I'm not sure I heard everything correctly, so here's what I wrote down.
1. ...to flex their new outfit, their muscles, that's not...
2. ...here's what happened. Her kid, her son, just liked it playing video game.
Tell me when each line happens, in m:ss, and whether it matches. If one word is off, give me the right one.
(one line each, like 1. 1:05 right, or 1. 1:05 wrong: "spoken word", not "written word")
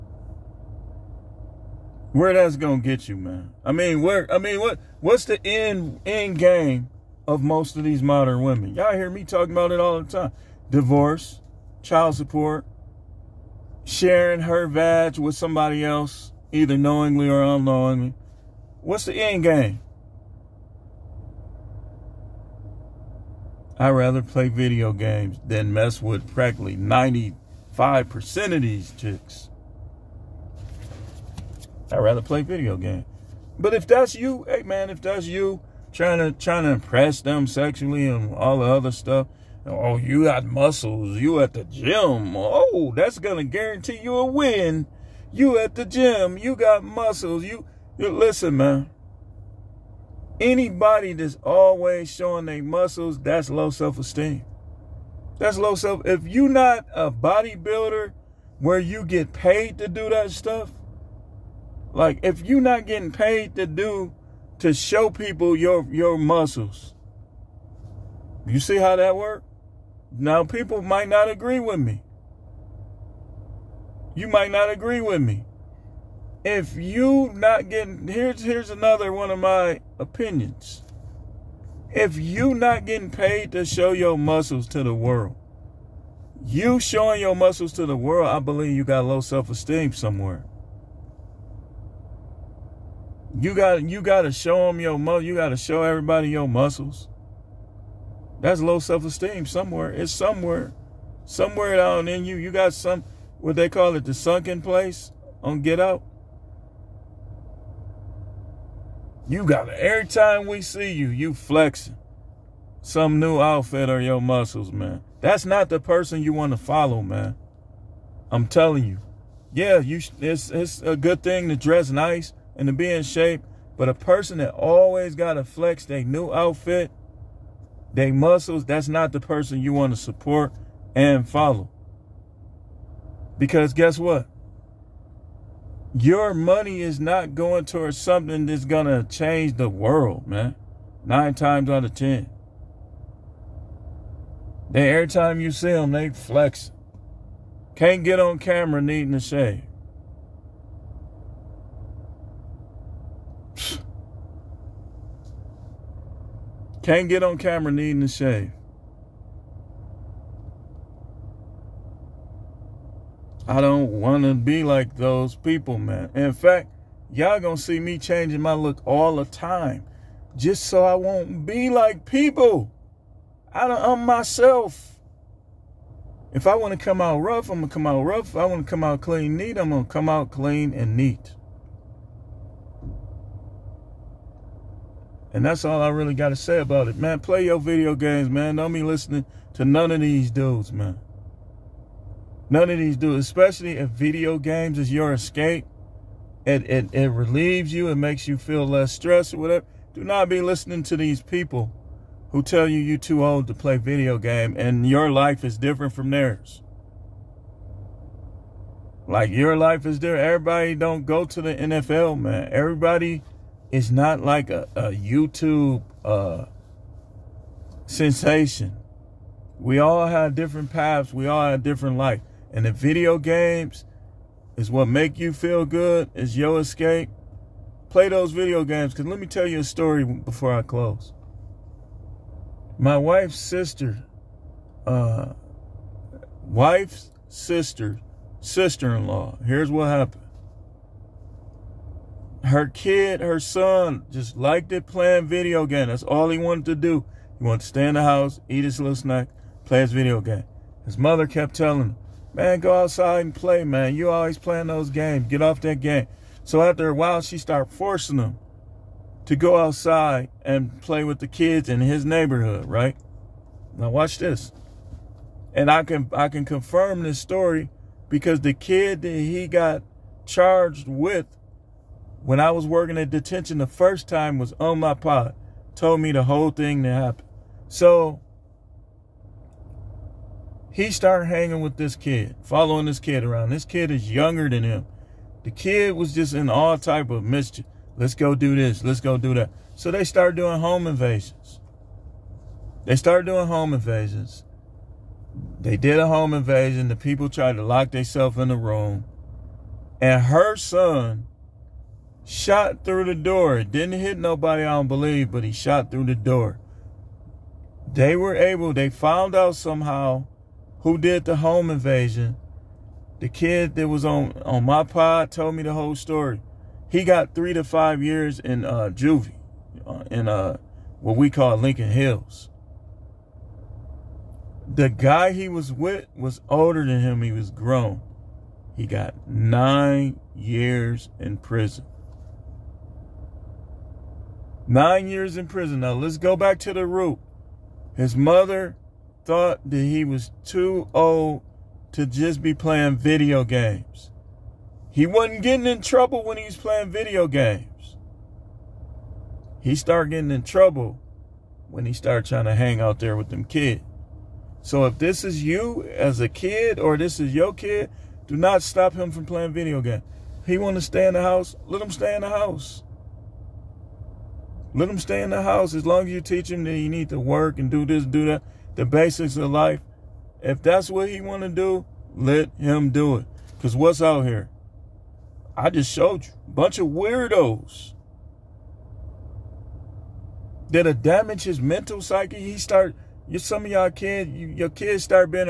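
1. 2:05 right
2. 3:59 right.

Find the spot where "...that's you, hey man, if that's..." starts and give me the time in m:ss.
0:33.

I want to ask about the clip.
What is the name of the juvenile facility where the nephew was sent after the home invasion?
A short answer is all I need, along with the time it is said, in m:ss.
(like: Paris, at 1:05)
Lincoln Hills, at 5:21.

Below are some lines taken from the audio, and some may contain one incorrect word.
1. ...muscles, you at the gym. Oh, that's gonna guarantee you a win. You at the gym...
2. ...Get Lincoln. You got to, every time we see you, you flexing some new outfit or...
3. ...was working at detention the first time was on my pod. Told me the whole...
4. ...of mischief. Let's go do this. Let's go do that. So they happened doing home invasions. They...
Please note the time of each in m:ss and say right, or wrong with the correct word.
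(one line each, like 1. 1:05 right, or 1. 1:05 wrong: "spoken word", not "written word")
1. 0:40 right
2. 1:45 wrong: "Out", not "Lincoln"
3. 4:32 right
4. 4:47 wrong: "started", not "happened".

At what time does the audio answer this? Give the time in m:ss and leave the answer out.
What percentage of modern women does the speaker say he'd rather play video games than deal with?
0:26.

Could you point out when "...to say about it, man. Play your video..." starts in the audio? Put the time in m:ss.
3:06.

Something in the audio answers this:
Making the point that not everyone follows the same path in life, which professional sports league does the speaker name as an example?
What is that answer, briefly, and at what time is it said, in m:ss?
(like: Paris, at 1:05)
NFL, at 3:31.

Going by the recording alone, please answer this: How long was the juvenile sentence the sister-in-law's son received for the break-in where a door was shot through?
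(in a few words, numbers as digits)
3 to 5 years.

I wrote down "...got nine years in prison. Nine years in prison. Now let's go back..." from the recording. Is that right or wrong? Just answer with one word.
right.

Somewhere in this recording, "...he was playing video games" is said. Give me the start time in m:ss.
5:46.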